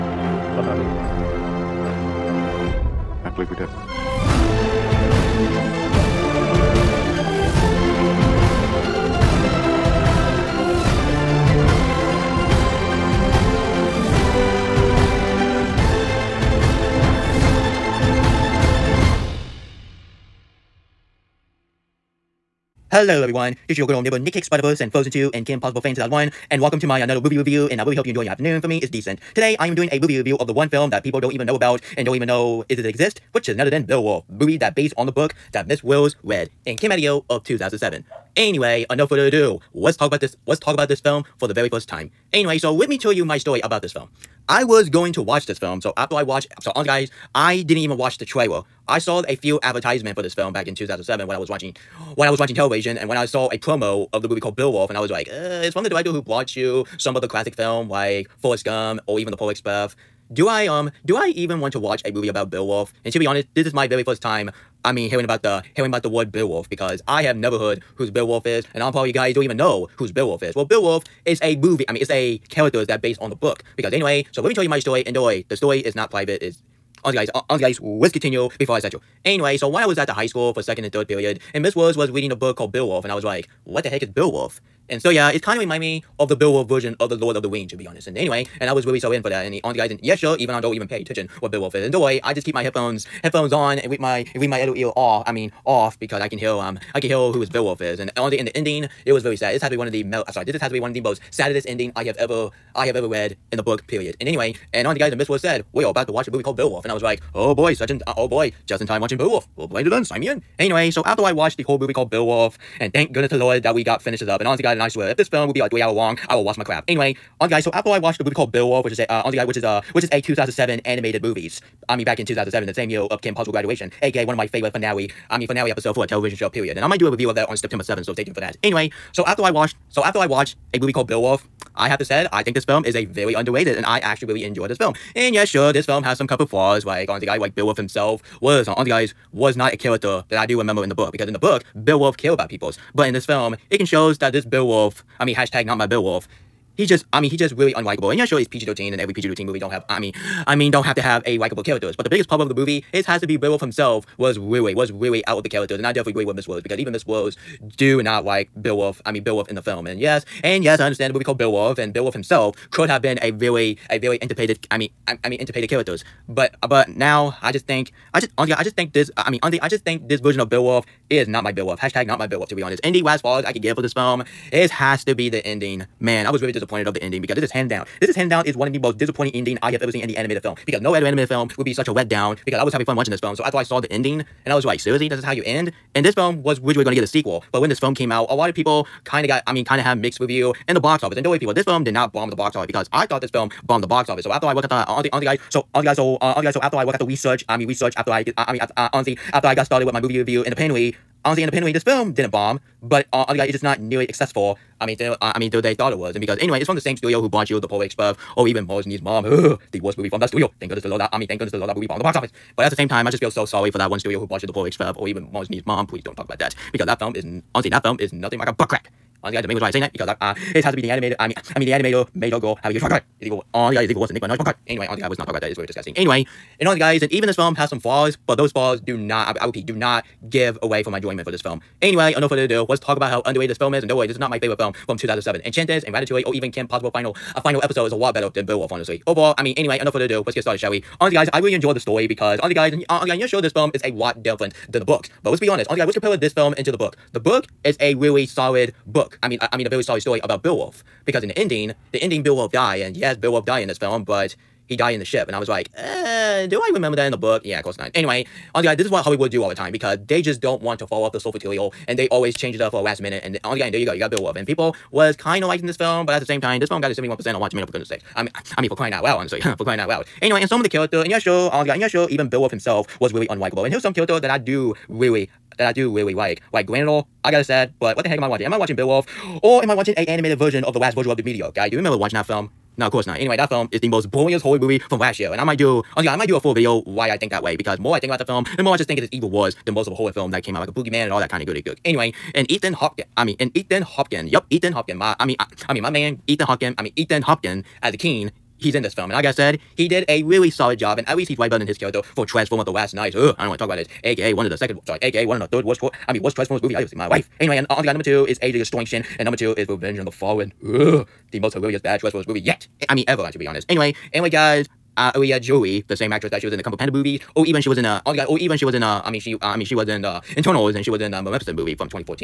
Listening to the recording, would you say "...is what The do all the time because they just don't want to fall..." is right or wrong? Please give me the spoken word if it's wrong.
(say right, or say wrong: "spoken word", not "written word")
wrong: "Hollywood", not "The".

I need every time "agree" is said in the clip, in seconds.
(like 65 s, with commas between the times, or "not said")
156 s.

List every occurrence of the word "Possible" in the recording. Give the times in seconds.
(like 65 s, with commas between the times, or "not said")
25 s, 123 s, 236 s.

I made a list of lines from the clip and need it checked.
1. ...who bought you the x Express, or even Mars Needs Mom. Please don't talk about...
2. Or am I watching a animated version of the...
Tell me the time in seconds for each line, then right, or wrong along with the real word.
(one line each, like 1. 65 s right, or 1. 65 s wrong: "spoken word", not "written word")
1. 214 s right
2. 279 s right.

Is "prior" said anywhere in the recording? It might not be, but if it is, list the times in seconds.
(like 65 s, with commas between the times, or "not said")
not said.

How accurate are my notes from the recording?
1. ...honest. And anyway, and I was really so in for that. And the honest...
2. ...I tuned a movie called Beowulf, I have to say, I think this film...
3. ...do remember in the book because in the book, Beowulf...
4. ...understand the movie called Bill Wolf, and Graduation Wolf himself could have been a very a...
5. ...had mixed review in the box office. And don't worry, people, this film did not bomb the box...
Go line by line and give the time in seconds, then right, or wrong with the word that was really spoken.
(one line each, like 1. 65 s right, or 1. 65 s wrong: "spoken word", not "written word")
1. 87 s right
2. 130 s wrong: "watched", not "tuned"
3. 140 s right
4. 160 s wrong: "Bill", not "Graduation"
5. 189 s right.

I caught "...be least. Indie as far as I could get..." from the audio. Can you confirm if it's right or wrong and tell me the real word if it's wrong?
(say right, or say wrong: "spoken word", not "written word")
wrong: "honest", not "least".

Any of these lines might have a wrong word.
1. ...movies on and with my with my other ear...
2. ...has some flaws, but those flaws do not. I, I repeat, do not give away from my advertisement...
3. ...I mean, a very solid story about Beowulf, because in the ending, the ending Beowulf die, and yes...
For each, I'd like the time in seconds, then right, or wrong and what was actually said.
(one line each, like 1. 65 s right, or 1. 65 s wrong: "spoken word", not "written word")
1. 93 s wrong: "headphones", not "movies"
2. 227 s wrong: "enjoyment", not "advertisement"
3. 249 s right.